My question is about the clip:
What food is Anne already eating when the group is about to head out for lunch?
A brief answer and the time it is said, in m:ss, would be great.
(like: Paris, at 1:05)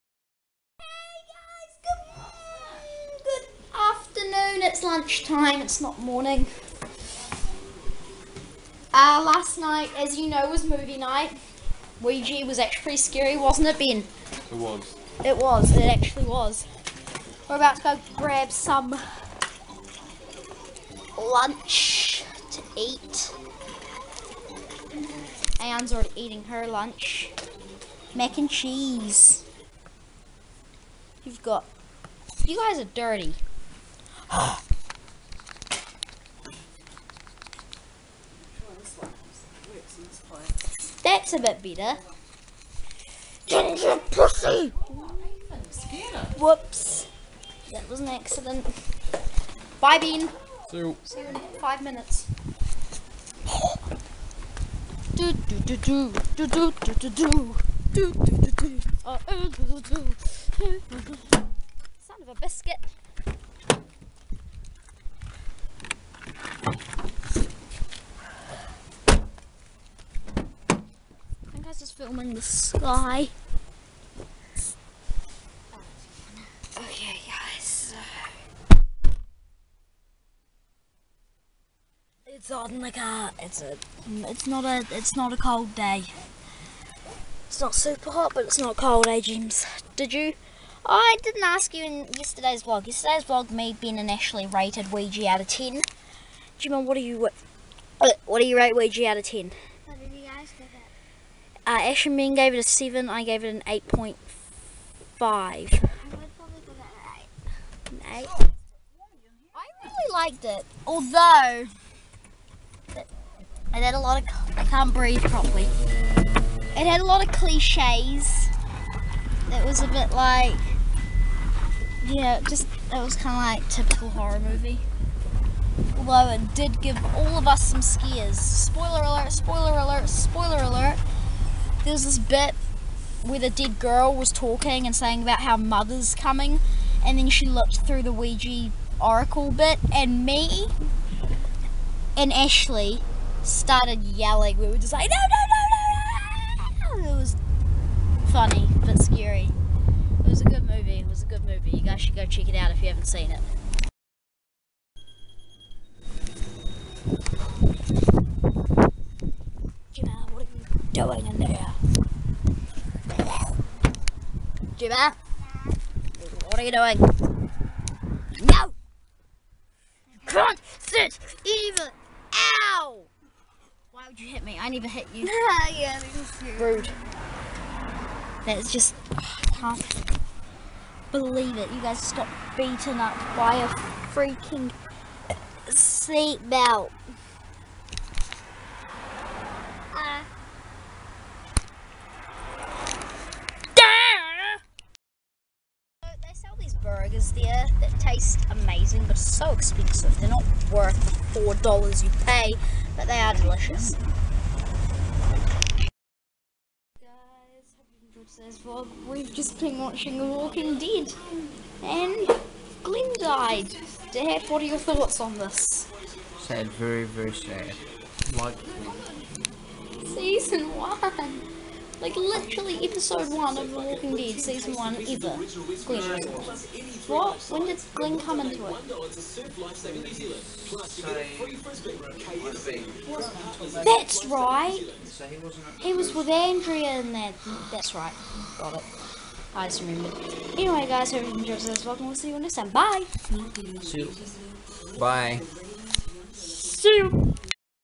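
Mac and cheese, at 0:28.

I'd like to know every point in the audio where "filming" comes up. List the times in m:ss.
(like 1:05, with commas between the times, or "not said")
1:11.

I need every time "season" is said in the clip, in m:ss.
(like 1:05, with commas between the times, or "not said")
3:40, 3:44.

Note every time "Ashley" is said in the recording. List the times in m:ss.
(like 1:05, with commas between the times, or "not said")
1:34, 2:22.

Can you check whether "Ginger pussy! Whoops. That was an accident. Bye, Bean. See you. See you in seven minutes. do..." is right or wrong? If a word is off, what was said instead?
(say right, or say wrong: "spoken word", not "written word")
wrong: "five", not "seven".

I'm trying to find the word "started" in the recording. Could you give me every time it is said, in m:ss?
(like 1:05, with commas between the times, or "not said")
2:23.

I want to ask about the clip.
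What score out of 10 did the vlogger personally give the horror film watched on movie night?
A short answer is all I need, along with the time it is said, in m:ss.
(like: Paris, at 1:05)
8.5, at 1:43.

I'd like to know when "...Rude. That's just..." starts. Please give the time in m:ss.
2:56.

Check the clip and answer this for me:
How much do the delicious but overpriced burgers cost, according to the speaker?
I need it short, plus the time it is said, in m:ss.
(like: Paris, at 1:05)
$4, at 3:21.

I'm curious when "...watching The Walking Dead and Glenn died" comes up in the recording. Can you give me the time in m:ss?
3:29.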